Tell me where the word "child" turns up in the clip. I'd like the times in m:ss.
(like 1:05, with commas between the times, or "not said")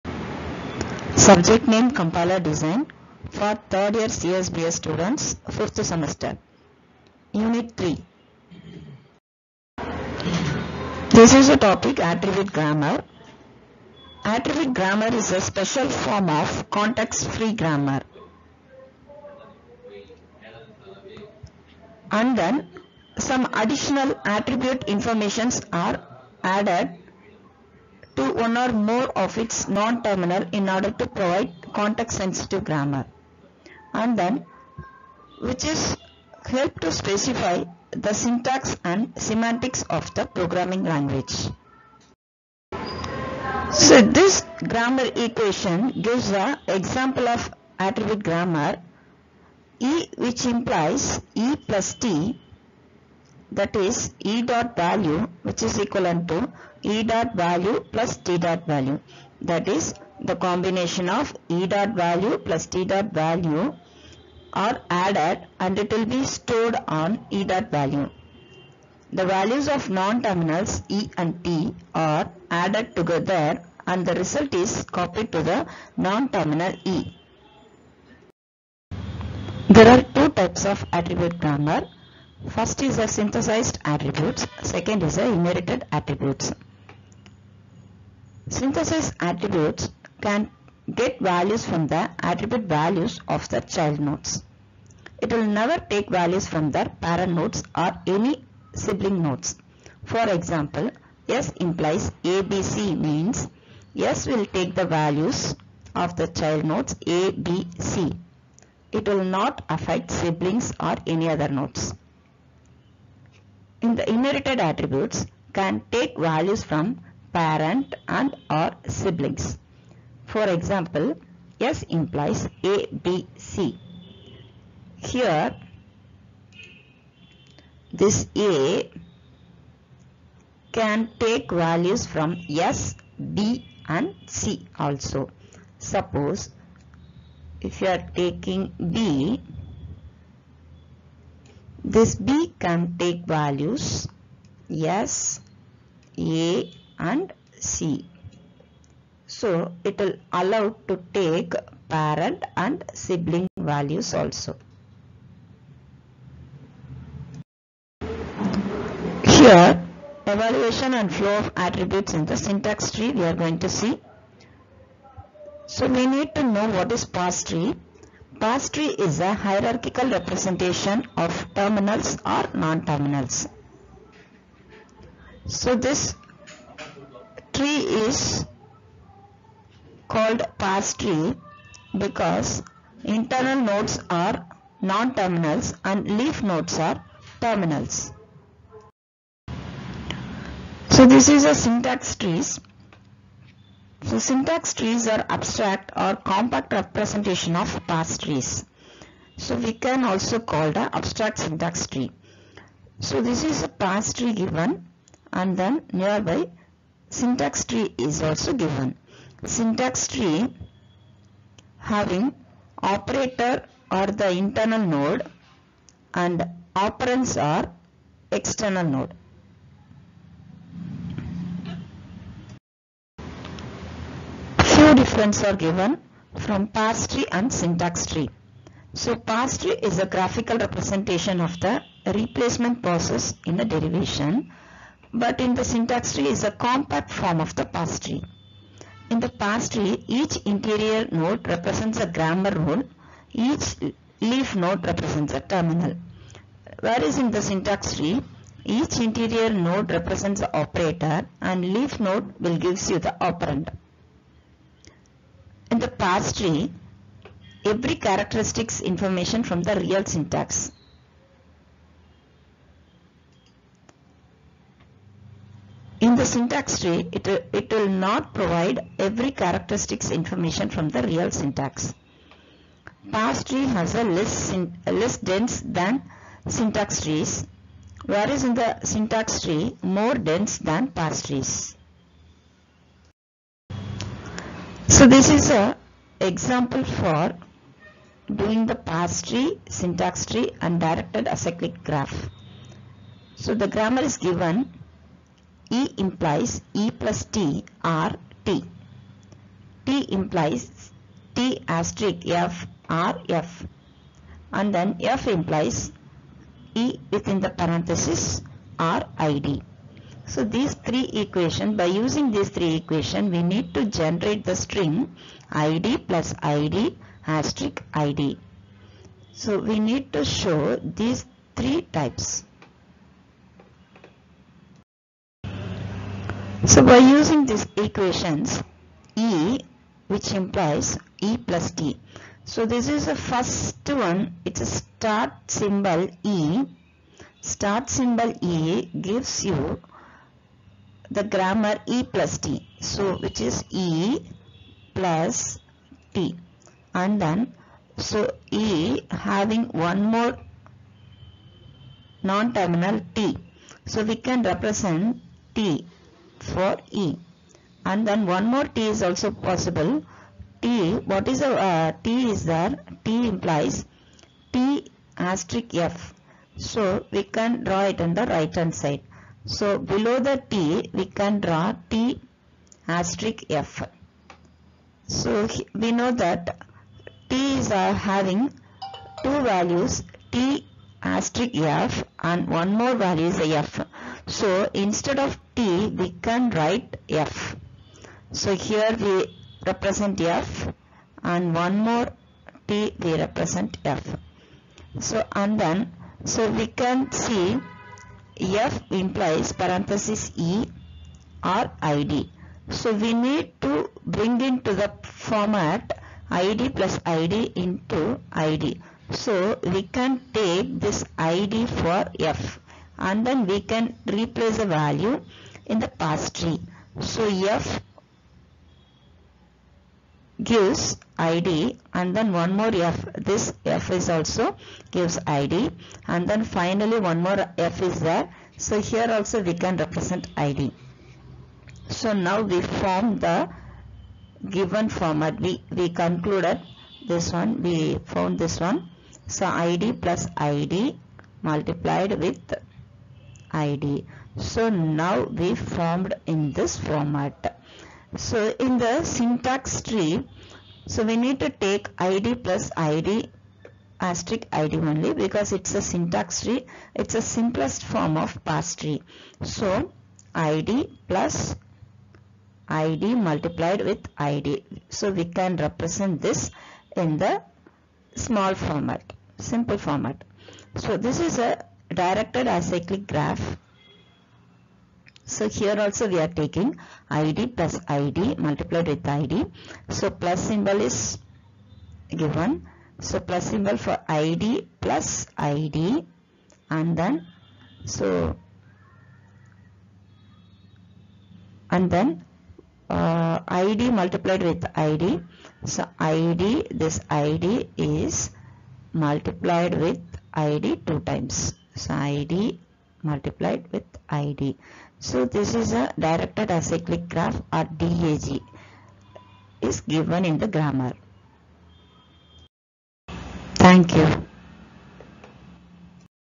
1:33, 1:46.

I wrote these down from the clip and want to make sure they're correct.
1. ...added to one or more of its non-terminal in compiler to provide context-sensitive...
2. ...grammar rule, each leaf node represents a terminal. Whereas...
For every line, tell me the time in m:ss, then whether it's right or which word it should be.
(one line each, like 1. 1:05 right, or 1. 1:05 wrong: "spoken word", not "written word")
1. 0:26 wrong: "order", not "compiler"
2. 4:02 right.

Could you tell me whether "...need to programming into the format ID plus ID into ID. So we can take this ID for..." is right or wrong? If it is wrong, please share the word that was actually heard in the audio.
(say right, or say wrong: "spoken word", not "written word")
wrong: "bring", not "programming".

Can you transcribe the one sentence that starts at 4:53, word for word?
So the grammar is given E implies E plus T R T.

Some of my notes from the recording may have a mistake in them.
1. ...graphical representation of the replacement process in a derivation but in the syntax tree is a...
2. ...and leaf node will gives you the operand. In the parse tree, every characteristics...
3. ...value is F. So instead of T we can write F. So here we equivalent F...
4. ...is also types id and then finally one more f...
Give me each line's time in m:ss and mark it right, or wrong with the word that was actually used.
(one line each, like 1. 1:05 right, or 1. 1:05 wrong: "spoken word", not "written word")
1. 3:50 right
2. 4:11 right
3. 6:22 wrong: "represent", not "equivalent"
4. 7:03 wrong: "gives", not "types".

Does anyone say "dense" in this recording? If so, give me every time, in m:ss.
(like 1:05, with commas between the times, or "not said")
4:35, 4:40.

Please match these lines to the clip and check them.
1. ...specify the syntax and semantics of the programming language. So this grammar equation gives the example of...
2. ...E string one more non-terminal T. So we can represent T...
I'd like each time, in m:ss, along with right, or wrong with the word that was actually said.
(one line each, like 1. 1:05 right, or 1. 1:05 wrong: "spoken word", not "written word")
1. 0:36 right
2. 5:48 wrong: "having", not "string".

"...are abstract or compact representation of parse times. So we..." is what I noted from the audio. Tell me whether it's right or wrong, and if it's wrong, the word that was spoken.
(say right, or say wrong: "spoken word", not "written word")
wrong: "trees", not "times".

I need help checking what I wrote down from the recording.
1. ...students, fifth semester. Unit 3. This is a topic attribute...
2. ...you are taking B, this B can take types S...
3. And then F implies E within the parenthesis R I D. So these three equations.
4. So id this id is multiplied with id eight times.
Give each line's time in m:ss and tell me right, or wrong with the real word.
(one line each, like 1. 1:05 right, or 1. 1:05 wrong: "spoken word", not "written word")
1. 0:04 right
2. 2:17 wrong: "values", not "types"
3. 5:04 right
4. 8:15 wrong: "two", not "eight".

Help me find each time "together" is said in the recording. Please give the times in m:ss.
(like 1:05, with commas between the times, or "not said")
1:12.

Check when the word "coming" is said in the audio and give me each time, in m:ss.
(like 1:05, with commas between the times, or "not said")
not said.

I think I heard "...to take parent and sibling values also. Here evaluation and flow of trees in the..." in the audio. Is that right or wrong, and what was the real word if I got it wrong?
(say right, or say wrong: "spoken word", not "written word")
wrong: "attributes", not "trees".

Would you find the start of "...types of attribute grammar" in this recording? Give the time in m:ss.
1:20.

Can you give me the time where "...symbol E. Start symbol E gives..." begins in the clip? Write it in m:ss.
5:35.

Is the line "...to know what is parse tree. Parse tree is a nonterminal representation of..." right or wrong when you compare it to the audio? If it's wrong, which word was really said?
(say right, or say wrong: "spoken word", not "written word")
wrong: "hierarchical", not "nonterminal".